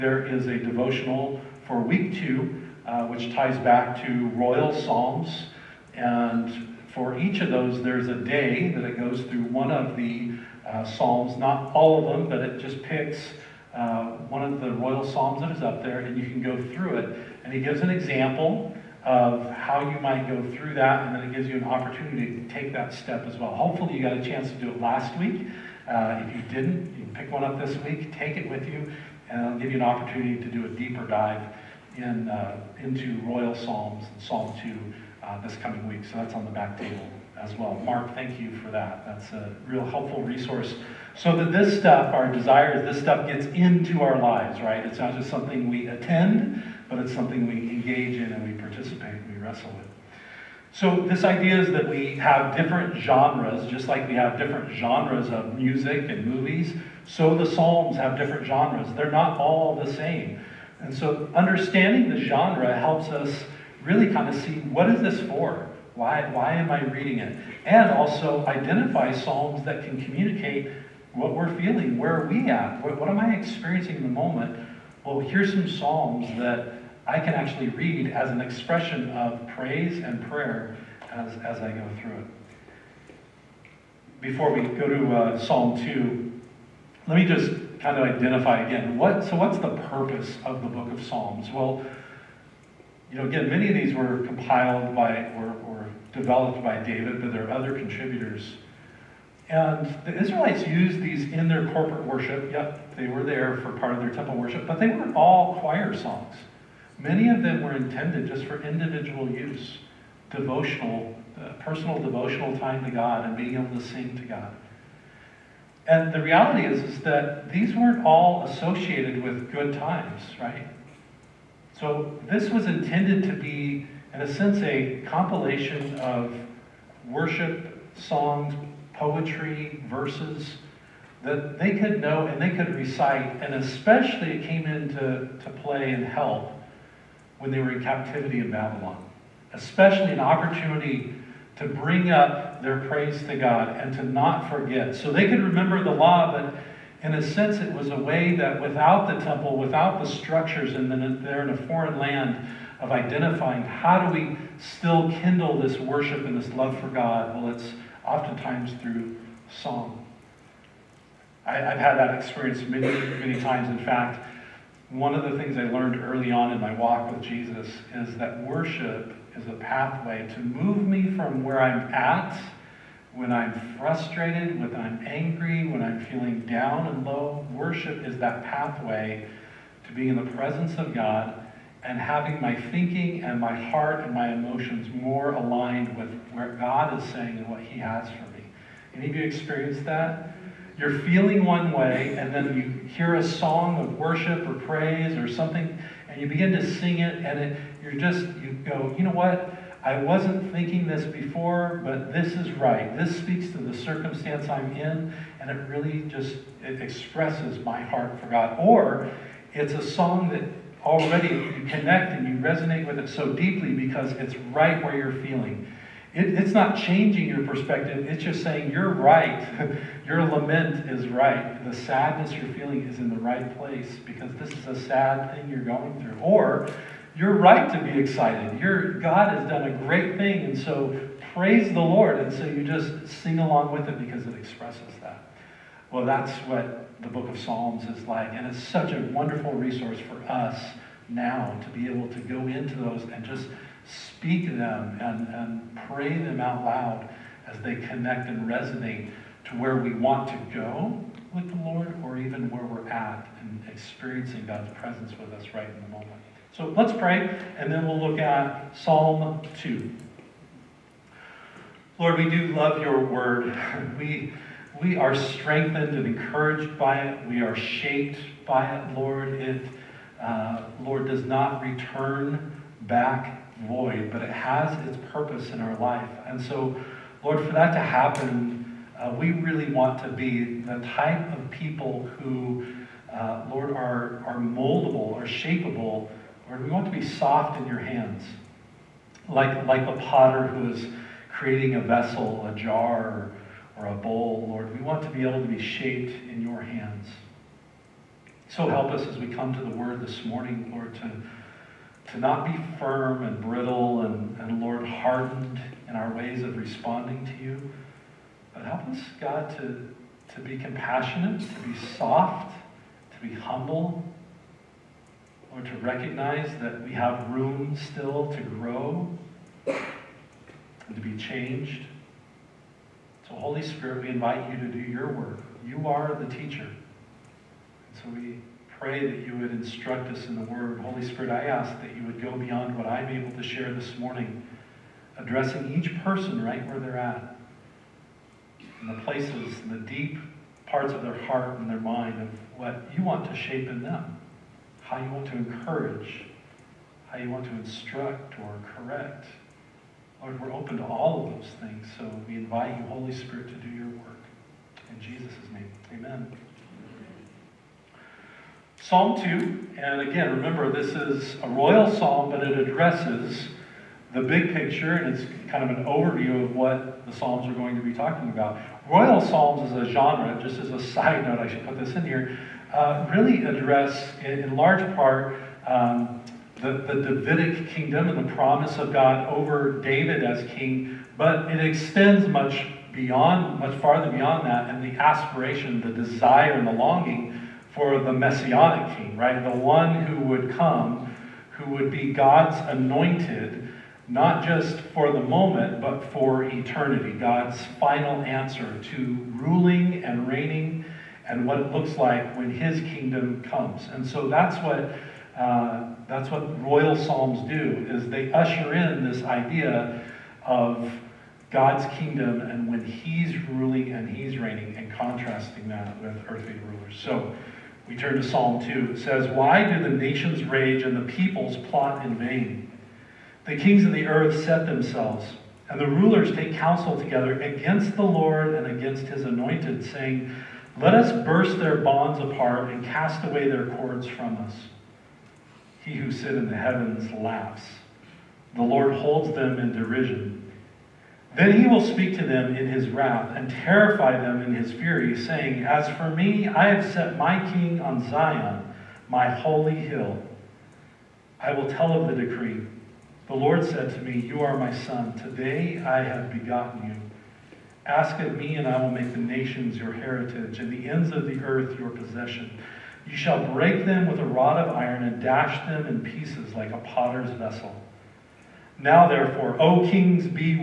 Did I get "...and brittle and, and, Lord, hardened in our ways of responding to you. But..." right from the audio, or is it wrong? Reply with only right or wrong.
right.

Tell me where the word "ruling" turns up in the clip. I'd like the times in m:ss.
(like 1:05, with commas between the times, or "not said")
6:39, 6:53.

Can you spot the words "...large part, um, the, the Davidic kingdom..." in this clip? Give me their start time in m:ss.
6:14.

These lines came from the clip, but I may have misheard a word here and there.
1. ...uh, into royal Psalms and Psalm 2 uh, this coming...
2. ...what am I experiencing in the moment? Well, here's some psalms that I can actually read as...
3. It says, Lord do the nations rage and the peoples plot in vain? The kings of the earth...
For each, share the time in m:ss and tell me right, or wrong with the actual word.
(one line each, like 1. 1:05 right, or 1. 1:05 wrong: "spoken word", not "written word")
1. 0:32 right
2. 1:12 right
3. 6:58 wrong: "Why", not "Lord".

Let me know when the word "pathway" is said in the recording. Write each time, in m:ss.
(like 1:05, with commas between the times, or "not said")
2:49, 2:58.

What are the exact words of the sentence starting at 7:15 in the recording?
He who sit in the heavens laughs.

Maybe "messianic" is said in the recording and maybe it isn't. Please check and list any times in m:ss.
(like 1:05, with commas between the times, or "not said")
6:28.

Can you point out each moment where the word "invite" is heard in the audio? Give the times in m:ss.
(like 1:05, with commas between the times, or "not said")
5:24, 5:52.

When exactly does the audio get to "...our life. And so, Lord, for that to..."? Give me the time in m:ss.
4:35.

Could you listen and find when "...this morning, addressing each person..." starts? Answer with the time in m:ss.
5:33.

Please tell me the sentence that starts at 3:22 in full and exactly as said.
This speaks to the circumstance I'm in, and it really just it expresses my heart for God.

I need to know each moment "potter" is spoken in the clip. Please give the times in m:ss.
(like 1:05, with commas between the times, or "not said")
4:49, 7:46.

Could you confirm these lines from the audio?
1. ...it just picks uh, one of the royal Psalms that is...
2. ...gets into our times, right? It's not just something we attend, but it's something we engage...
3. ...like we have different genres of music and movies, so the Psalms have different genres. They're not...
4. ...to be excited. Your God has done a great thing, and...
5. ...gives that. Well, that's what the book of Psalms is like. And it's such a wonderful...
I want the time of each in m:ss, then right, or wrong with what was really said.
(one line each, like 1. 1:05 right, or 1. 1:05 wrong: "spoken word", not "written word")
1. 0:12 right
2. 0:43 wrong: "lives", not "times"
3. 0:53 right
4. 3:47 right
5. 3:54 wrong: "expresses", not "gives".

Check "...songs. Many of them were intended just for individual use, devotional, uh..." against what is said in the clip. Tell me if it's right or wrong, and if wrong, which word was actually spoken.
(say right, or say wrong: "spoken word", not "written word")
right.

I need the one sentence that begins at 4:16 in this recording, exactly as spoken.
So let's pray, and then we'll look at Psalm 2.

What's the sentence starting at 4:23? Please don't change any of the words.
We, we are strengthened and encouraged by it.